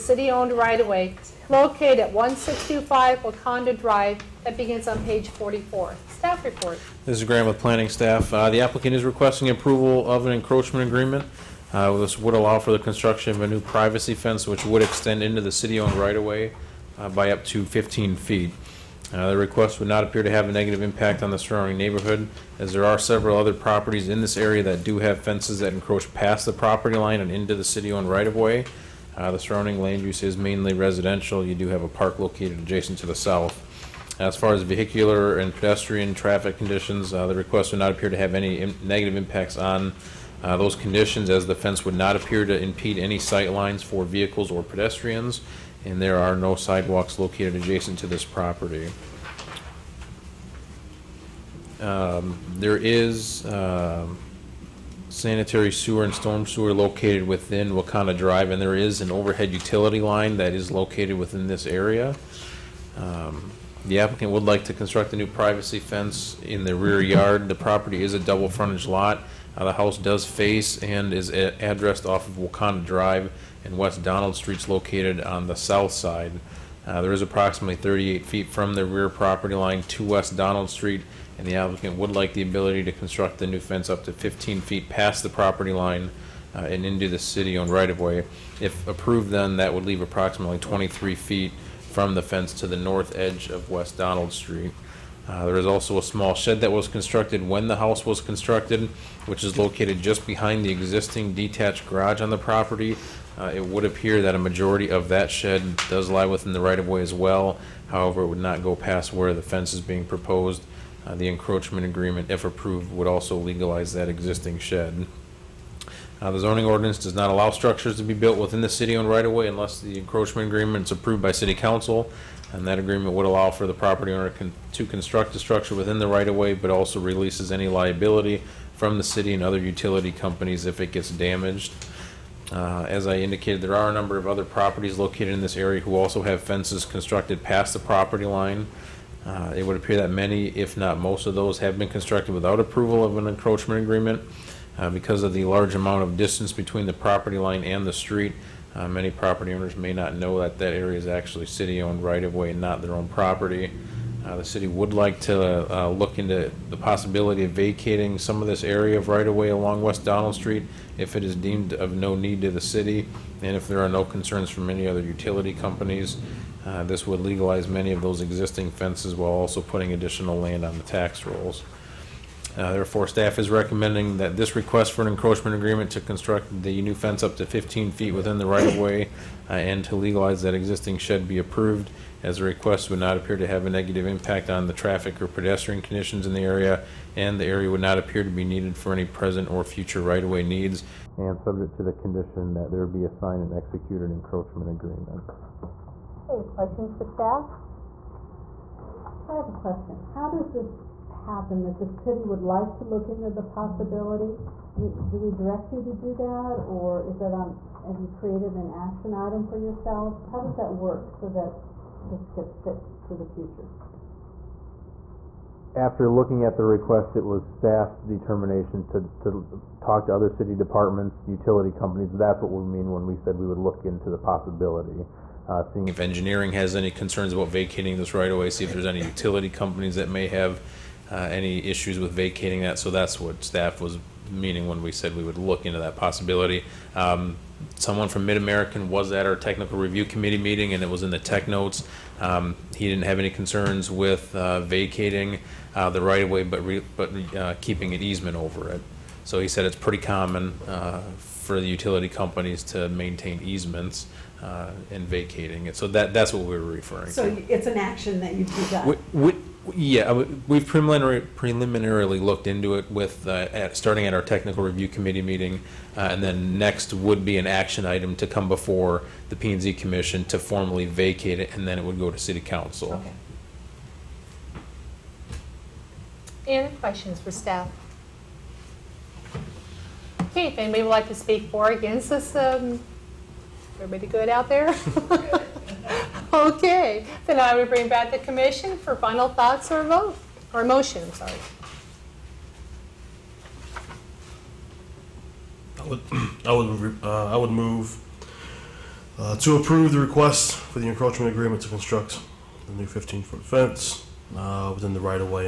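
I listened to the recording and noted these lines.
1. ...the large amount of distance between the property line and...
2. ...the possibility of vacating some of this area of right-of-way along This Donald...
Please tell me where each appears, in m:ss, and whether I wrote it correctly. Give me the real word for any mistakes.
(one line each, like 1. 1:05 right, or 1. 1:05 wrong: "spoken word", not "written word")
1. 2:25 right
2. 2:36 wrong: "West", not "This".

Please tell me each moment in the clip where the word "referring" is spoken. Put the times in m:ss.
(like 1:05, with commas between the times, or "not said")
4:16.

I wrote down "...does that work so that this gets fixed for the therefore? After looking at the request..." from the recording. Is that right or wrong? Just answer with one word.
wrong.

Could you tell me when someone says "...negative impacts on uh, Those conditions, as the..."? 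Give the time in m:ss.
0:38.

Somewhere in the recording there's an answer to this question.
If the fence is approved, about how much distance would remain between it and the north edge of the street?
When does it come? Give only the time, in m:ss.
1:30.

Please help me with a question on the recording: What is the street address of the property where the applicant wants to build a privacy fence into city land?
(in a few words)
1625 Wakanda Drive.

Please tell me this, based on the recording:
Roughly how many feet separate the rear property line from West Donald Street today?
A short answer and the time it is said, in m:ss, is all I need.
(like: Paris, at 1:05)
38 feet, at 1:17.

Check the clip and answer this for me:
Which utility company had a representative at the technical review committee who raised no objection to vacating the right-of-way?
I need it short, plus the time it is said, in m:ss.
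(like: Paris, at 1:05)
MidAmerican, at 3:58.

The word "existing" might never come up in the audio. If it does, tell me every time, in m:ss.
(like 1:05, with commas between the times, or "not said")
1:40, 1:54, 2:48, 3:00.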